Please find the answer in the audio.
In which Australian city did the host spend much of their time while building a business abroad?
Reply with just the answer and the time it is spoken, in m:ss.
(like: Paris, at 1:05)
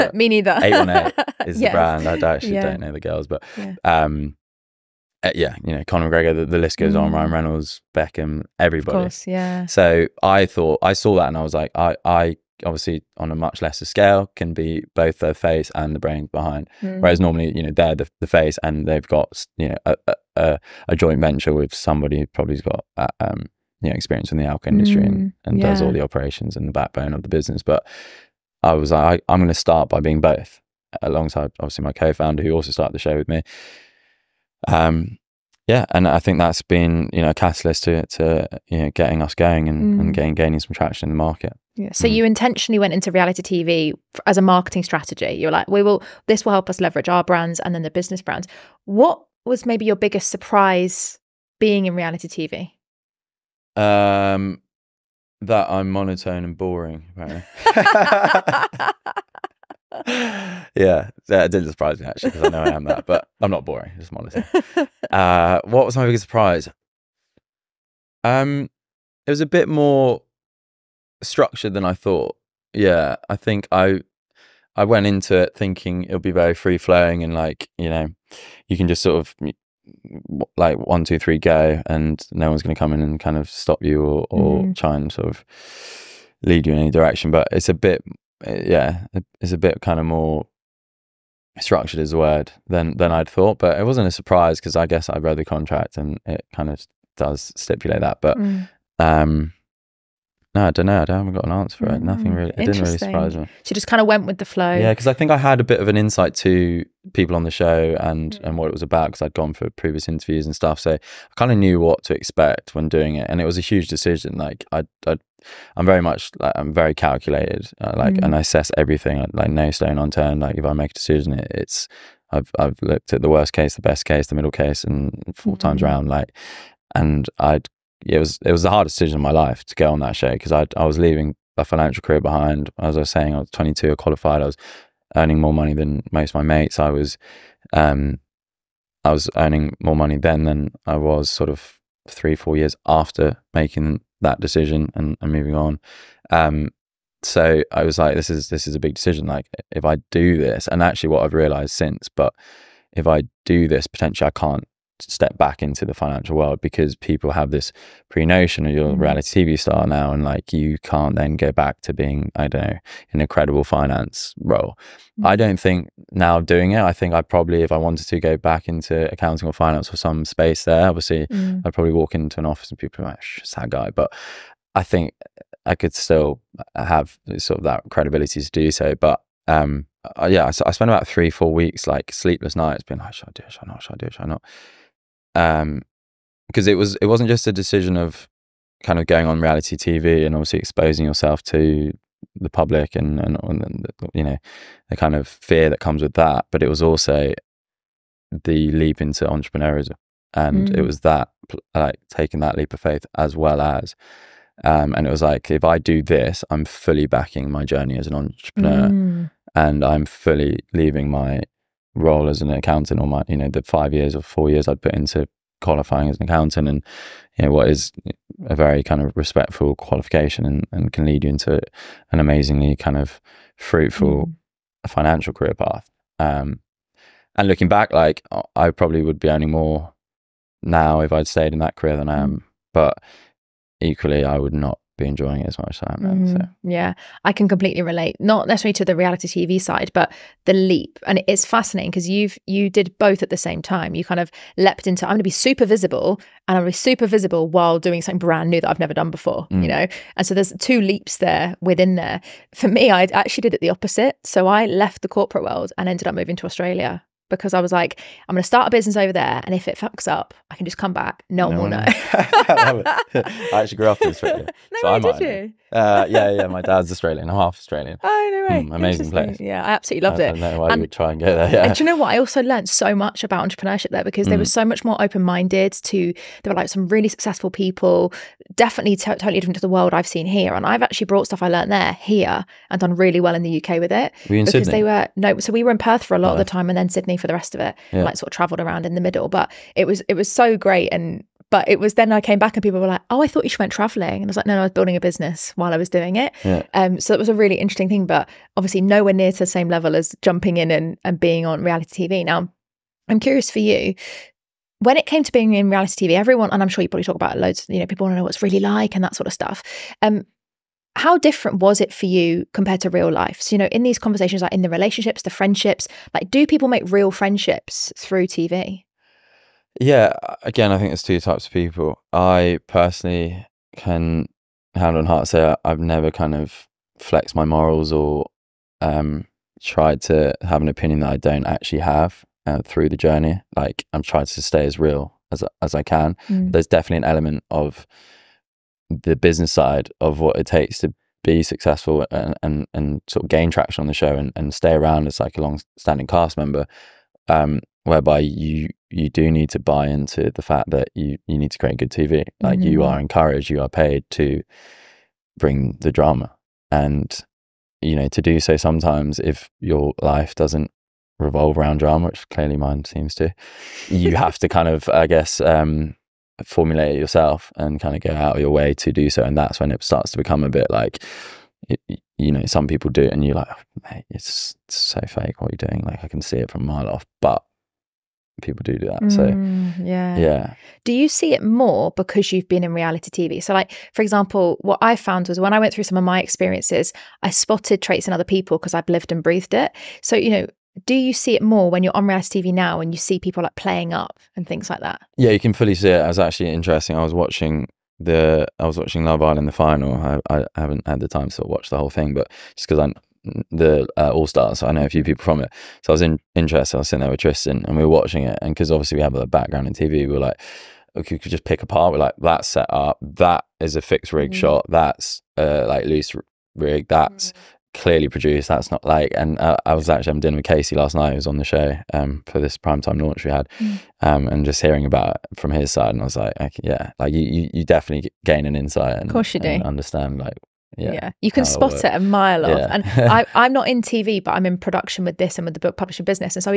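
Perth, at 4:45.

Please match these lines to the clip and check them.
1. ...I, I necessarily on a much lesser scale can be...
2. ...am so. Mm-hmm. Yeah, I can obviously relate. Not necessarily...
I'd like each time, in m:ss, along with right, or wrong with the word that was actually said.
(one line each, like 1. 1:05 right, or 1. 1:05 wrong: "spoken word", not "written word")
1. 0:11 wrong: "obviously", not "necessarily"
2. 3:56 wrong: "completely", not "obviously".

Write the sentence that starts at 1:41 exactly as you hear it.
I haven't got an answer for it.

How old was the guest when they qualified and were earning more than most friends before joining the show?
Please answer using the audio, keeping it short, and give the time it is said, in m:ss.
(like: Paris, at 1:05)
22, at 2:13.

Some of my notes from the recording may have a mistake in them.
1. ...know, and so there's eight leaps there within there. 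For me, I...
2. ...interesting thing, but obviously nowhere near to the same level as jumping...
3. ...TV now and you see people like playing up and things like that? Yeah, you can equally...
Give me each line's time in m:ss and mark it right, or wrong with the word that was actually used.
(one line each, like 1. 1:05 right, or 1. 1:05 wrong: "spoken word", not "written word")
1. 4:09 wrong: "two", not "eight"
2. 4:57 right
3. 6:32 wrong: "fully", not "equally".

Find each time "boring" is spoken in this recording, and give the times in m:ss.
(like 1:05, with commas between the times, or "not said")
0:56, 1:03.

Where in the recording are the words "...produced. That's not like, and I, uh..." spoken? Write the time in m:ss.
6:58.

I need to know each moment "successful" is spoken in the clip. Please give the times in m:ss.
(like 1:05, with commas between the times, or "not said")
4:37, 5:41.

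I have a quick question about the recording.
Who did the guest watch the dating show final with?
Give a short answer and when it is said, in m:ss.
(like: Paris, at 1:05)
Tristan, at 6:47.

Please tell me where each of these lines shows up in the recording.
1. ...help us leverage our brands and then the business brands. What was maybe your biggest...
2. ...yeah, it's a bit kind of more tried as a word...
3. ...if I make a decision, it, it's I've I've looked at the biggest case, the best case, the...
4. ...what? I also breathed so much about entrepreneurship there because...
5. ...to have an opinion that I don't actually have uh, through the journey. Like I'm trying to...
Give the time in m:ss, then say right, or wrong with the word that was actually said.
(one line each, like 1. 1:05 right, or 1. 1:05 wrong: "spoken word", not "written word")
1. 0:46 right
2. 1:28 wrong: "structured", not "tried"
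3. 2:00 wrong: "worst", not "biggest"
4. 4:31 wrong: "learned", not "breathed"
5. 5:30 right.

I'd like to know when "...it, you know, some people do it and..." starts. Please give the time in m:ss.
6:11.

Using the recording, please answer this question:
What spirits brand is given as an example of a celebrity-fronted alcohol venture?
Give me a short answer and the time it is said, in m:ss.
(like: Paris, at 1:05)
818, at 0:00.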